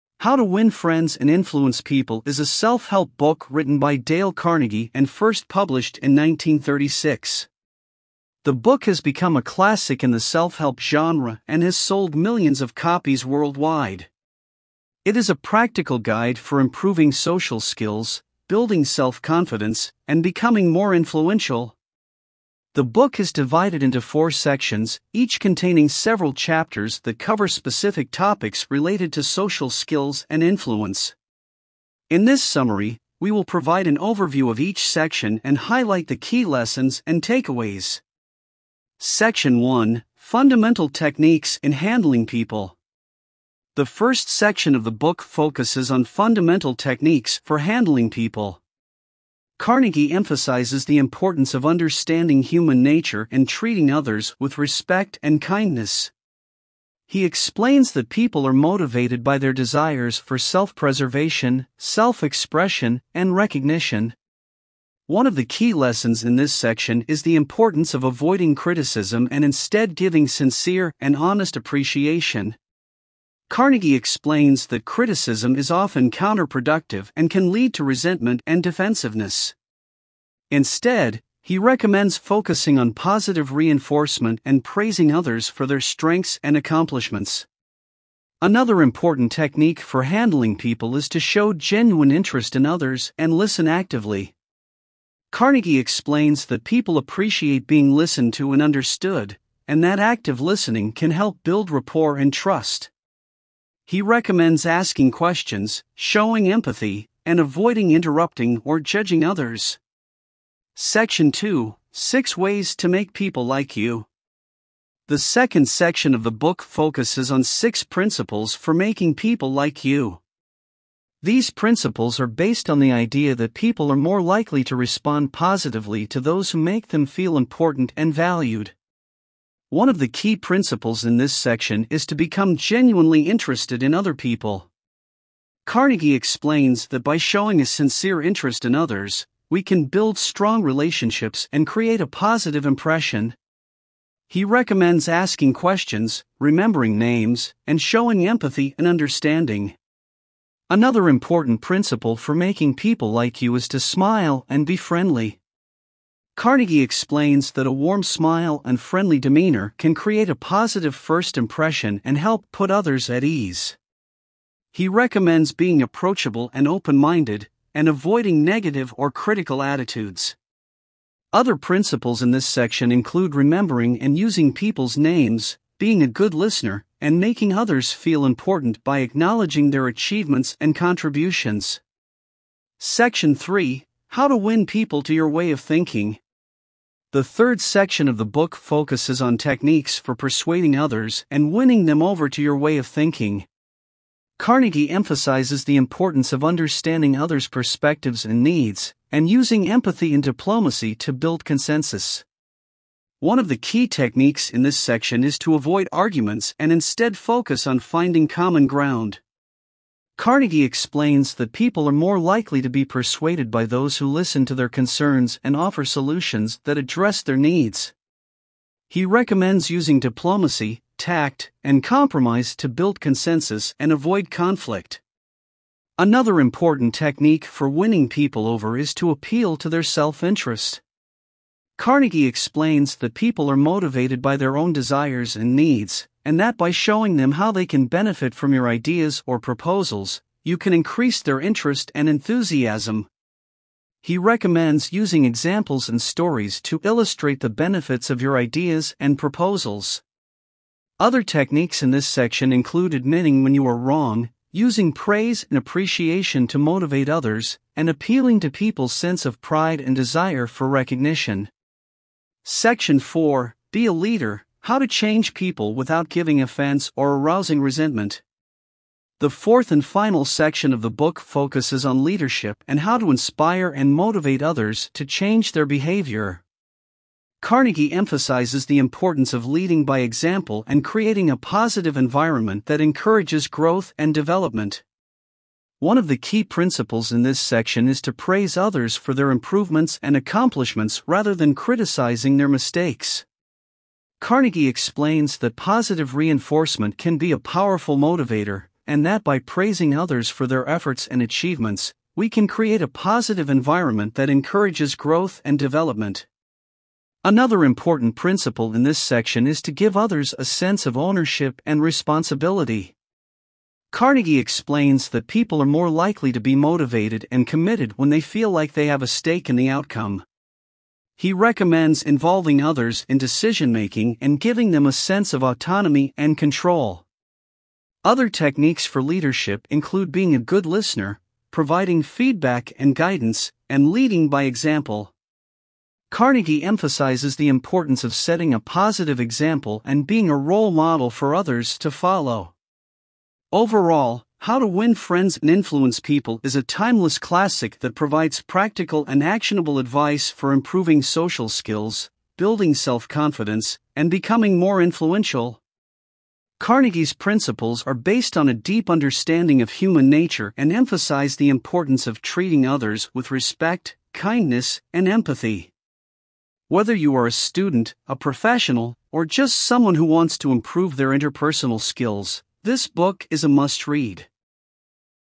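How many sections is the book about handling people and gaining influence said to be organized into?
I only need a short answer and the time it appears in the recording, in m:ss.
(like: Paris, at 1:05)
4, at 0:23.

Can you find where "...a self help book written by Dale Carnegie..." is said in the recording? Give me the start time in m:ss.
0:02.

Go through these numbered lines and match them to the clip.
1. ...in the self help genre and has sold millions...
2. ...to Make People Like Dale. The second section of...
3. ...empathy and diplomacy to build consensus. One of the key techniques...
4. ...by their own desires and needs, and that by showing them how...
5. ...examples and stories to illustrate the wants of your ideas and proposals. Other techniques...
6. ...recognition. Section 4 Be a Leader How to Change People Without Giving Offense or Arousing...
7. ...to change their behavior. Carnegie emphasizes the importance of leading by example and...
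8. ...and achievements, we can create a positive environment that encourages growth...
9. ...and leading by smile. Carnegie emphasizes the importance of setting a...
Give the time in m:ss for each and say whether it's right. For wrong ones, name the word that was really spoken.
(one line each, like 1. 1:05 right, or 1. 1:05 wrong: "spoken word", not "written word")
1. 0:10 right
2. 1:52 wrong: "You", not "Dale"
3. 3:19 right
4. 3:54 right
5. 4:05 wrong: "benefits", not "wants"
6. 4:20 right
7. 4:34 right
8. 5:01 right
9. 5:33 wrong: "example", not "smile".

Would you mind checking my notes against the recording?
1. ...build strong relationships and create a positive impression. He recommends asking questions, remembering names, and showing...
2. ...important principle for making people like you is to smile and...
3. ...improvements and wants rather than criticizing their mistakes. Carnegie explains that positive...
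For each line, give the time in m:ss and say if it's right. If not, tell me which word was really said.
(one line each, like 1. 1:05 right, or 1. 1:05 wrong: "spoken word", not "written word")
1. 2:19 right
2. 2:31 right
3. 4:49 wrong: "accomplishments", not "wants".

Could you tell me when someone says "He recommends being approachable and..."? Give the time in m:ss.
2:44.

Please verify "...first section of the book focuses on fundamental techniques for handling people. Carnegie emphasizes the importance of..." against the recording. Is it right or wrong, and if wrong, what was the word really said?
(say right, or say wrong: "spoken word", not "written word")
right.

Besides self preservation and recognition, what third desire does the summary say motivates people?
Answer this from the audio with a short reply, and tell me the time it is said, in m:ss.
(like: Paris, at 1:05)
Self expression, at 1:01.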